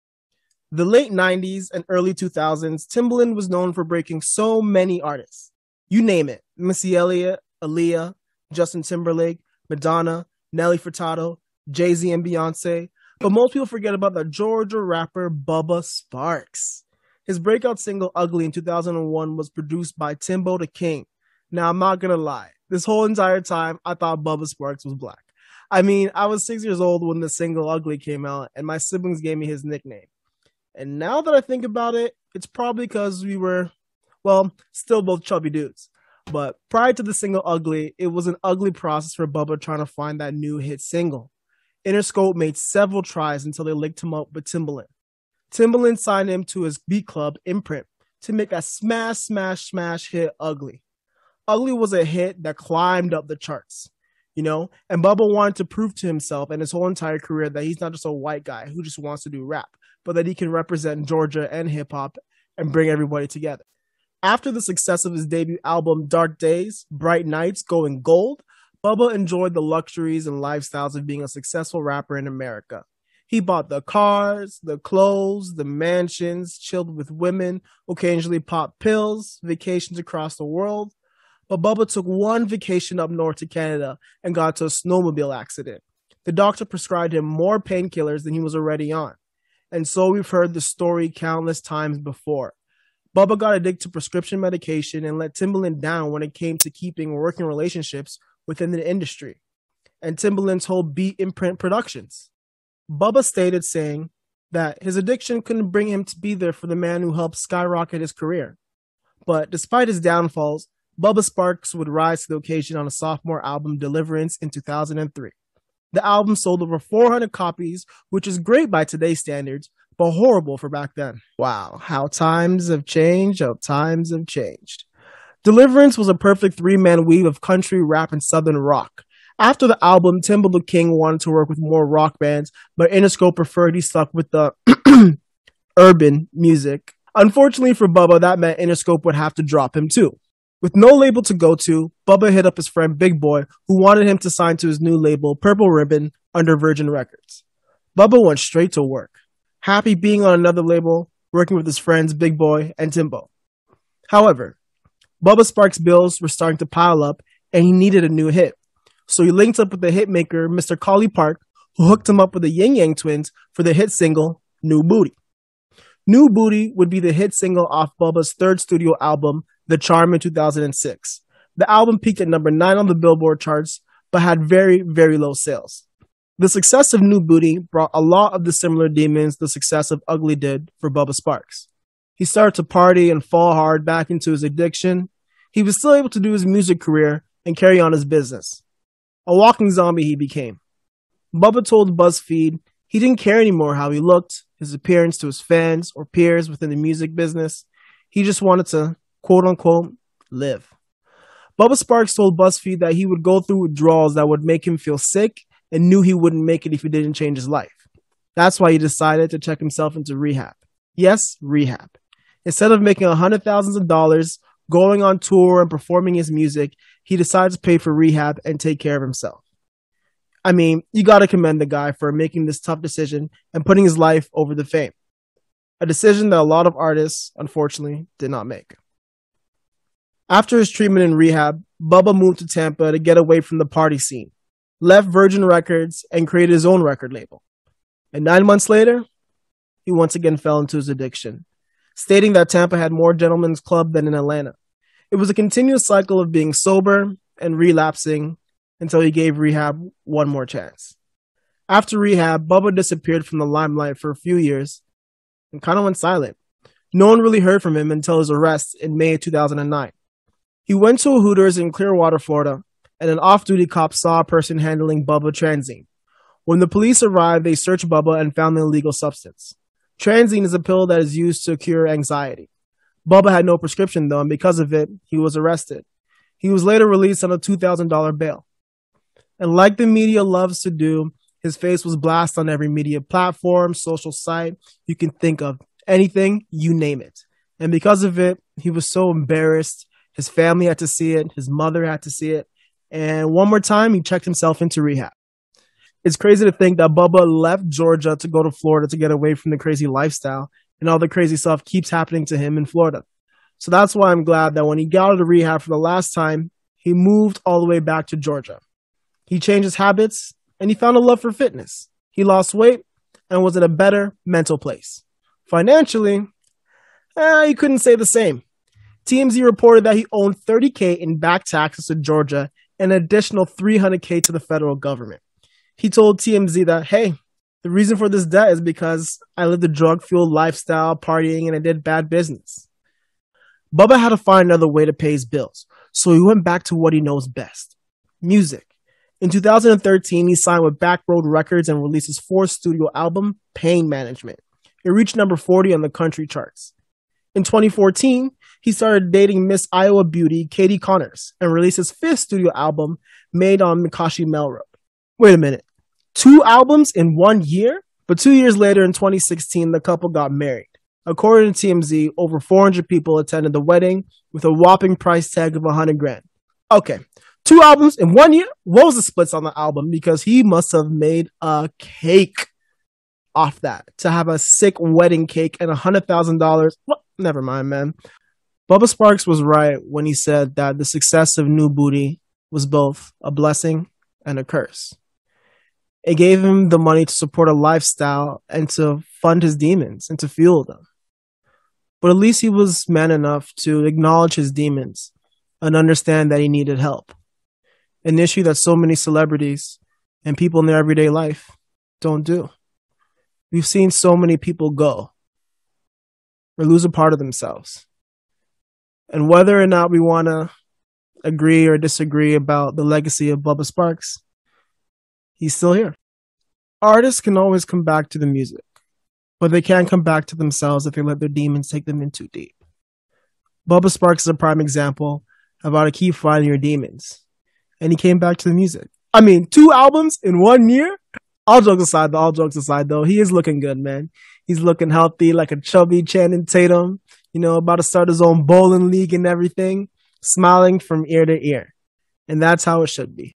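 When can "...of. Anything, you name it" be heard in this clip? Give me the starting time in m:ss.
4:45.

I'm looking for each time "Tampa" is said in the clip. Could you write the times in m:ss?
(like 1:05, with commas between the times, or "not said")
3:52, 4:02.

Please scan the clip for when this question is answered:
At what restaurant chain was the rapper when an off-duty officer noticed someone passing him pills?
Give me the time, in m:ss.
4:21.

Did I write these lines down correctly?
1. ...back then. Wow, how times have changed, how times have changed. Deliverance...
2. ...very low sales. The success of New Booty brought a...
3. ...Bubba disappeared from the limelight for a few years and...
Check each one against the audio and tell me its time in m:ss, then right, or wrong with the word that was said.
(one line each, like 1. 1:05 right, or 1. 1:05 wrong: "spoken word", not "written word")
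1. 2:00 right
2. 2:54 right
3. 4:12 right.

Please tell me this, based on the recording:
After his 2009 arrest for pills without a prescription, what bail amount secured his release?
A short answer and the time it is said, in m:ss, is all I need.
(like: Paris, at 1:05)
$2,000, at 4:37.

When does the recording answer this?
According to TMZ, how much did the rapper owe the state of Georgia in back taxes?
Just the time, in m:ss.
5:20.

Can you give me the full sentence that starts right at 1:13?
He bought the cars, the clothes, the mansions, chilled with women, occasionally popped pills, vacations across the world.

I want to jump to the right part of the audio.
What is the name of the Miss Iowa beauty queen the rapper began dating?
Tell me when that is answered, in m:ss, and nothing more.
5:50.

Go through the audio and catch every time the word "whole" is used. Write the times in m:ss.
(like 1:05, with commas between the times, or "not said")
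0:22, 0:56, 1:40.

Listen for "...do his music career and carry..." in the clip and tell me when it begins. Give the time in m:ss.
3:06.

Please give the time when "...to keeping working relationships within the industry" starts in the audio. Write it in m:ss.
1:36.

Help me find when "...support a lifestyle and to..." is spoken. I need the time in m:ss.
6:27.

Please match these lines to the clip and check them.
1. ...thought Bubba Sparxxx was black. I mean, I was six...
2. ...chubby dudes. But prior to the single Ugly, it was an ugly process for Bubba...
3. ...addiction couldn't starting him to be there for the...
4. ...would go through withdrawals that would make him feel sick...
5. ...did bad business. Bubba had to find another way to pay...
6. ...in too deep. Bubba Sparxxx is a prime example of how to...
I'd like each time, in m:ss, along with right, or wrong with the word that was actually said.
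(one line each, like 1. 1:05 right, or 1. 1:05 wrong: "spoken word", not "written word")
1. 0:23 right
2. 0:35 right
3. 1:44 wrong: "bring", not "starting"
4. 3:23 right
5. 5:31 right
6. 7:02 right.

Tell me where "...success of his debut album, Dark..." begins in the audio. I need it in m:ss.
1:04.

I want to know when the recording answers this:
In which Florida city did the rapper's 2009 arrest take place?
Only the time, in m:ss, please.
4:21.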